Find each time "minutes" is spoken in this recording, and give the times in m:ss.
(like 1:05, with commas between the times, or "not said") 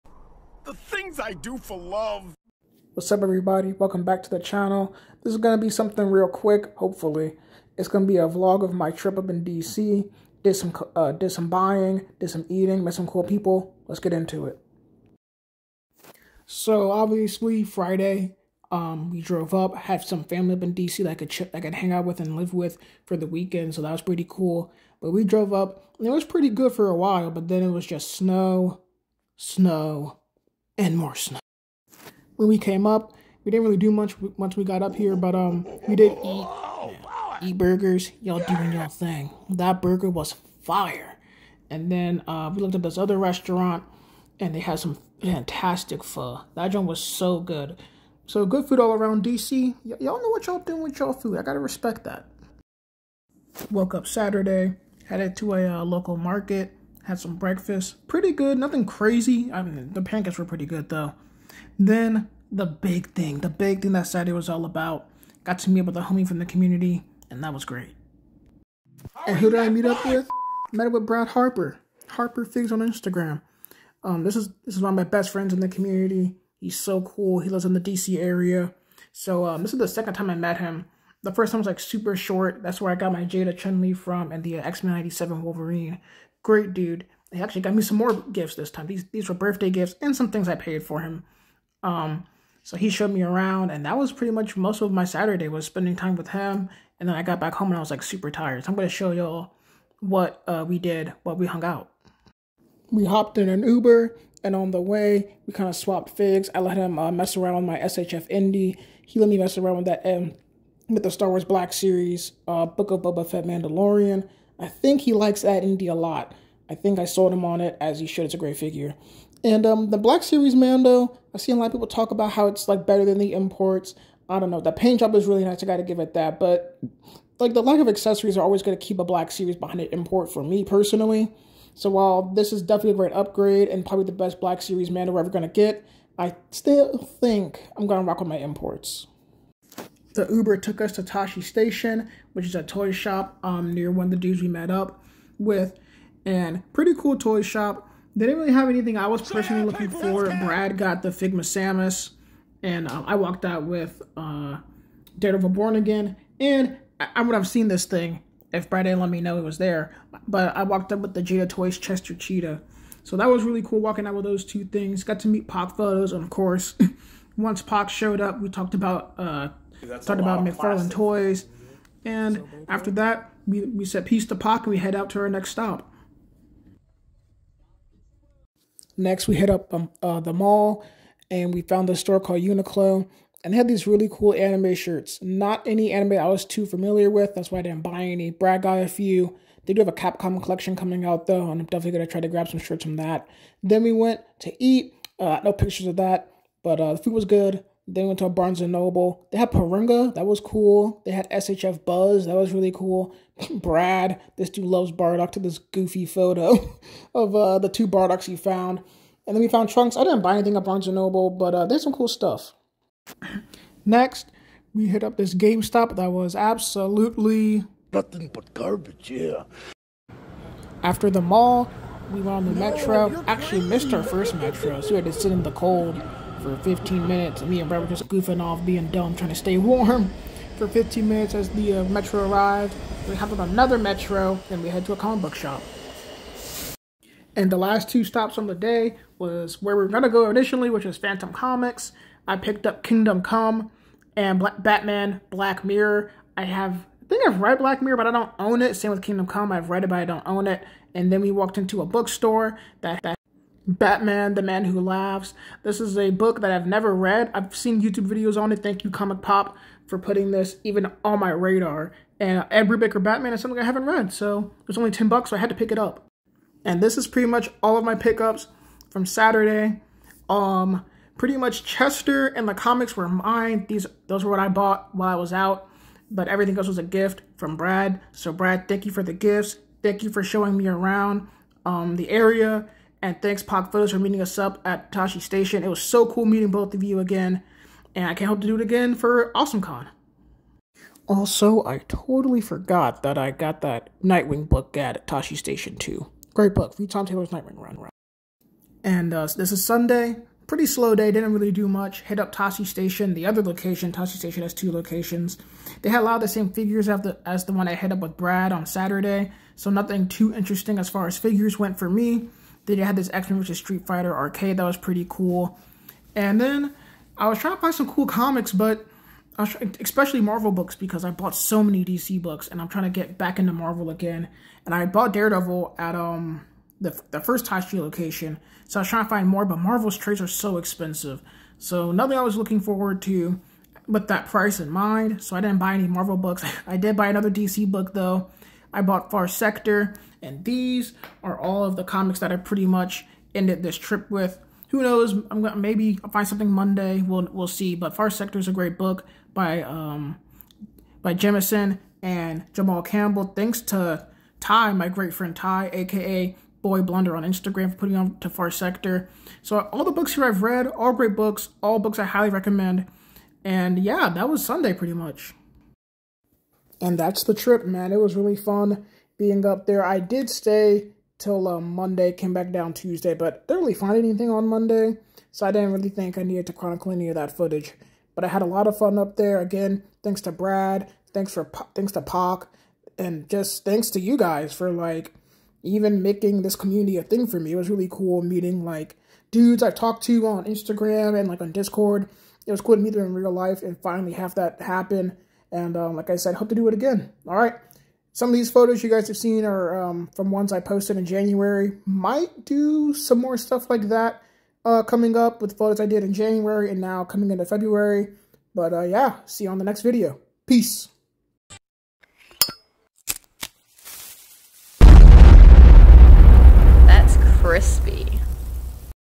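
3:47, 3:51.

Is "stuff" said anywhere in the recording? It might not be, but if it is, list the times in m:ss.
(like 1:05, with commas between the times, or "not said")
3:32, 6:43.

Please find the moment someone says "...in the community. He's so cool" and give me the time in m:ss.
1:15.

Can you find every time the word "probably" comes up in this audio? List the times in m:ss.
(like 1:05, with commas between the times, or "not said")
2:13.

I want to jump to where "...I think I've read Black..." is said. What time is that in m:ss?
4:07.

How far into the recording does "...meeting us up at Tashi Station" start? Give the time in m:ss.
4:43.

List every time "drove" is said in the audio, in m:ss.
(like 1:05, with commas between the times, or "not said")
0:19, 0:25.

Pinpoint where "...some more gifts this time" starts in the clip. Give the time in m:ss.
1:27.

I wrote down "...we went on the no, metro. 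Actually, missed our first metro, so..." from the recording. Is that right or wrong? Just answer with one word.
right.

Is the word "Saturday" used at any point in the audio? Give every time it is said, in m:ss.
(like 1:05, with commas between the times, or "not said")
0:54, 1:04, 1:35, 4:29, 5:08.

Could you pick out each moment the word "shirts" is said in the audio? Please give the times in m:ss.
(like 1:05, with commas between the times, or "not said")
3:04, 3:12.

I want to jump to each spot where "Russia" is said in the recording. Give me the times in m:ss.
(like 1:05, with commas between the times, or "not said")
not said.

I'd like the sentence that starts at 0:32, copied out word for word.
When we came up, we didn't really do much once we got up here, but um, we did eat, eat burgers.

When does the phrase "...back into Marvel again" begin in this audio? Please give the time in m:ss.
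5:23.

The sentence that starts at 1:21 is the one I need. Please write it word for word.
The first time was like super short.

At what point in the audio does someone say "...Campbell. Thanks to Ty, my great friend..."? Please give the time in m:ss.
5:52.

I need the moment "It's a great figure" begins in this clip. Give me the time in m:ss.
1:58.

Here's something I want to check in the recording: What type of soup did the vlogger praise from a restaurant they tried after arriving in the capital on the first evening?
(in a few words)
pho.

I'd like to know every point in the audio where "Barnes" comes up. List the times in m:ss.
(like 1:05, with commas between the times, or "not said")
3:18, 3:30.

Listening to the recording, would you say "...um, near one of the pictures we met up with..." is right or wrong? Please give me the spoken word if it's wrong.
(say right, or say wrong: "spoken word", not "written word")
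wrong: "dudes", not "pictures".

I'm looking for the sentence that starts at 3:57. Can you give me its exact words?
And the last two stops on the day was where we were gonna go initially, which was Phantom Comics.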